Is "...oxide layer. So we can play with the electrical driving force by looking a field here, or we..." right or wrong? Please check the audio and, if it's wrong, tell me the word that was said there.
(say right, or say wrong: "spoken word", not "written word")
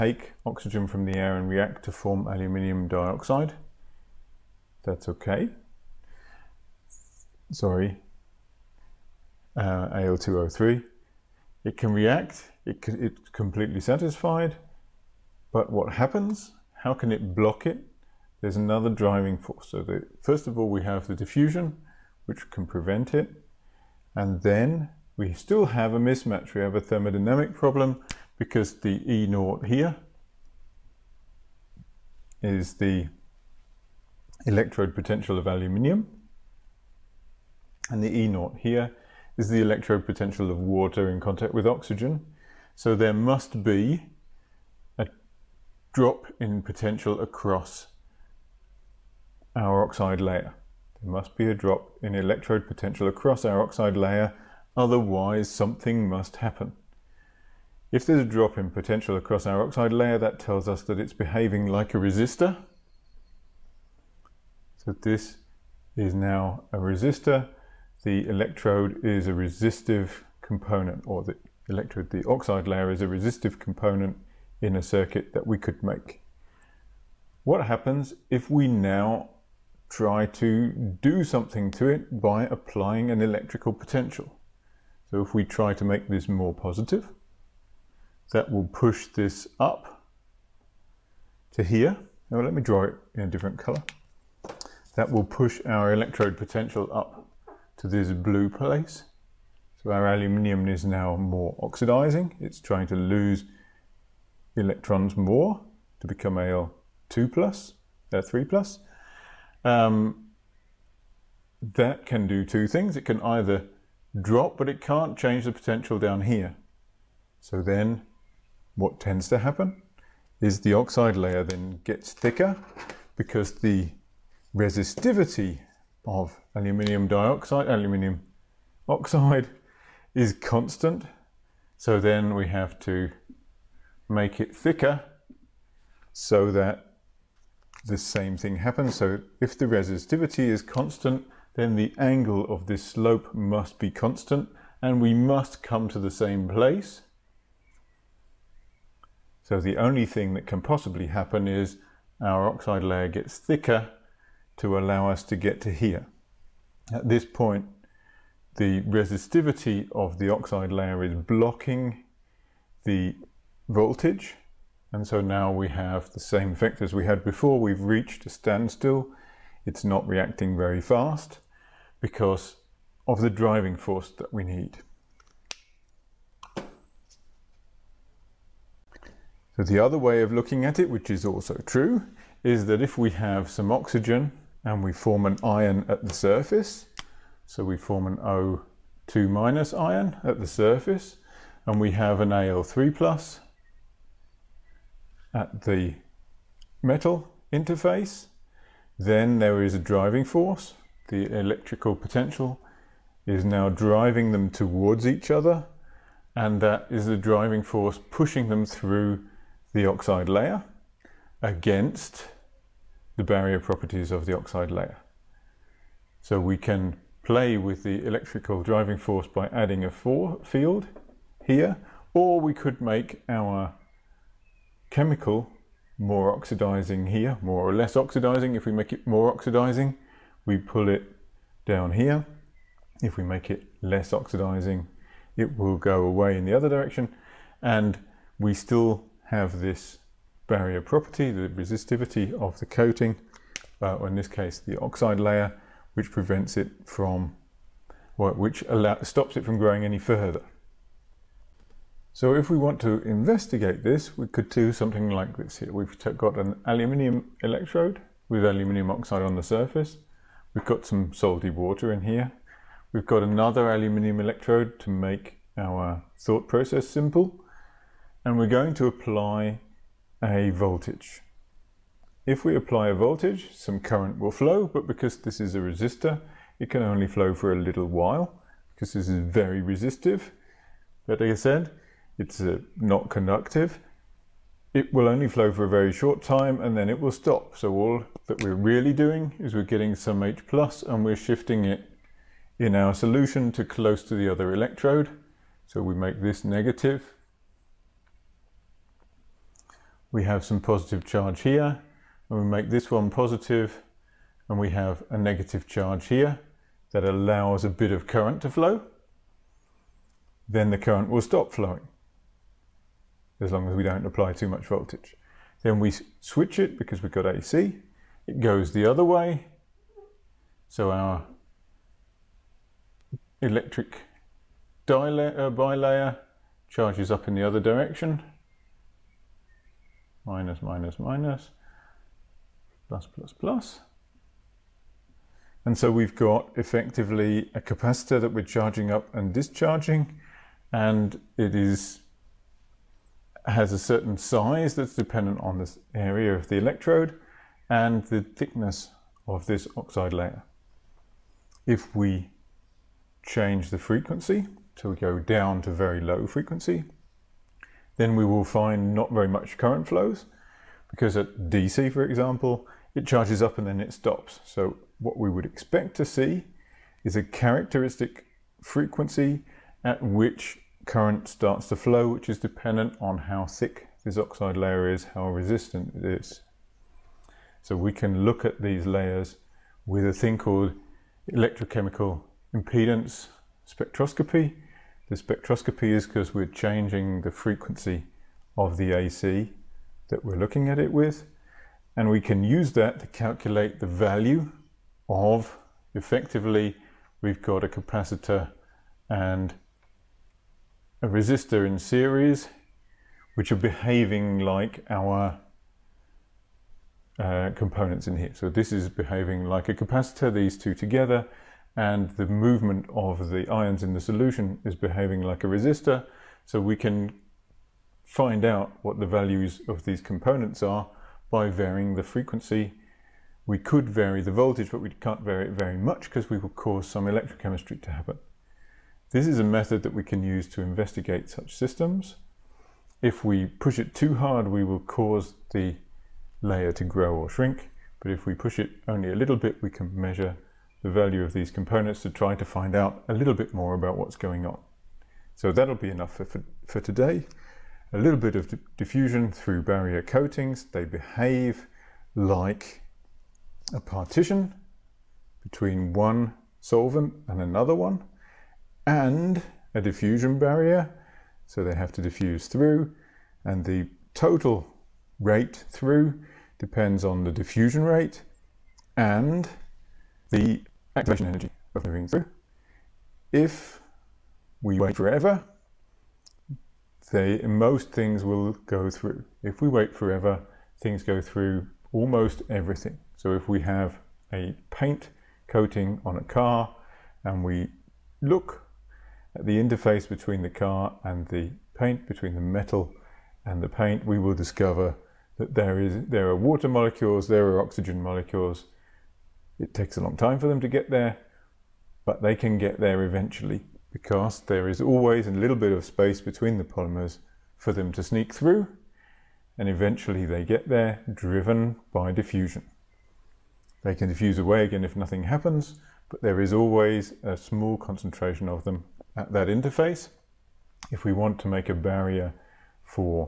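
wrong: "adding", not "looking".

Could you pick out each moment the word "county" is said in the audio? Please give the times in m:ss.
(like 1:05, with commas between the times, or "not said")
not said.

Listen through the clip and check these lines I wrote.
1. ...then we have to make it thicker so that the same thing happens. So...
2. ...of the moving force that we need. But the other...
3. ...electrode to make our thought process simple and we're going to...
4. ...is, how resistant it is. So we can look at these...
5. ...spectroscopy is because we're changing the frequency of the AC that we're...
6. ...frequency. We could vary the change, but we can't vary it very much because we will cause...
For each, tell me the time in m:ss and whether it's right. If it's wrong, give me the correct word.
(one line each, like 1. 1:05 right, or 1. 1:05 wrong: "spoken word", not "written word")
1. 2:11 right
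2. 2:53 wrong: "driving", not "moving"
3. 4:24 right
4. 6:14 right
5. 6:25 right
6. 7:02 wrong: "voltage", not "change".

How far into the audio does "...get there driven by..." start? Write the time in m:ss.
8:30.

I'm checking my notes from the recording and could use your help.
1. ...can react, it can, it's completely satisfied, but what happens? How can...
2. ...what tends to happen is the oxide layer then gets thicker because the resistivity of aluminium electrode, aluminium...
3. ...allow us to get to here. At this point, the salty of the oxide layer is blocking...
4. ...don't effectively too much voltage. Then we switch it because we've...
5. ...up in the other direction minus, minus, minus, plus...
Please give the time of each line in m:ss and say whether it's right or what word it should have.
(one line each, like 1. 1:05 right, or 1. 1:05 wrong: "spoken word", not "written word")
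1. 0:11 right
2. 1:58 wrong: "dioxide", not "electrode"
3. 2:34 wrong: "resistivity", not "salty"
4. 5:13 wrong: "apply", not "effectively"
5. 5:27 right.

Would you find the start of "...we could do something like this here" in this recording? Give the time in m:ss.
4:14.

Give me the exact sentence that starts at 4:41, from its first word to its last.
But like I said, it's uh, not conductive.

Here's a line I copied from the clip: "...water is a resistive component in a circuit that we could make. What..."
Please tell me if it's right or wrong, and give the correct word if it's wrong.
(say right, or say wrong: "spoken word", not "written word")
wrong: "layer", not "water".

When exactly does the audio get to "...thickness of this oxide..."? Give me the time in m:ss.
5:48.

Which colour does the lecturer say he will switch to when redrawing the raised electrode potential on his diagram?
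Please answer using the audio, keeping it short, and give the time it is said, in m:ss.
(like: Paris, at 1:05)
Blue, at 1:38.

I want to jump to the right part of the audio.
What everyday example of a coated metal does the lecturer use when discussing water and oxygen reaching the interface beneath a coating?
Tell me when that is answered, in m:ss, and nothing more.
8:04.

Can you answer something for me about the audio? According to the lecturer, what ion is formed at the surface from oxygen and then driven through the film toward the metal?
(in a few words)
O2- ion.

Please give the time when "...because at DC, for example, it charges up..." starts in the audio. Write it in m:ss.
6:00.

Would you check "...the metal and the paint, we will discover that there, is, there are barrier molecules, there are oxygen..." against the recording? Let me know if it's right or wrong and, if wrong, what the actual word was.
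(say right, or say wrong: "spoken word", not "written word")
wrong: "water", not "barrier".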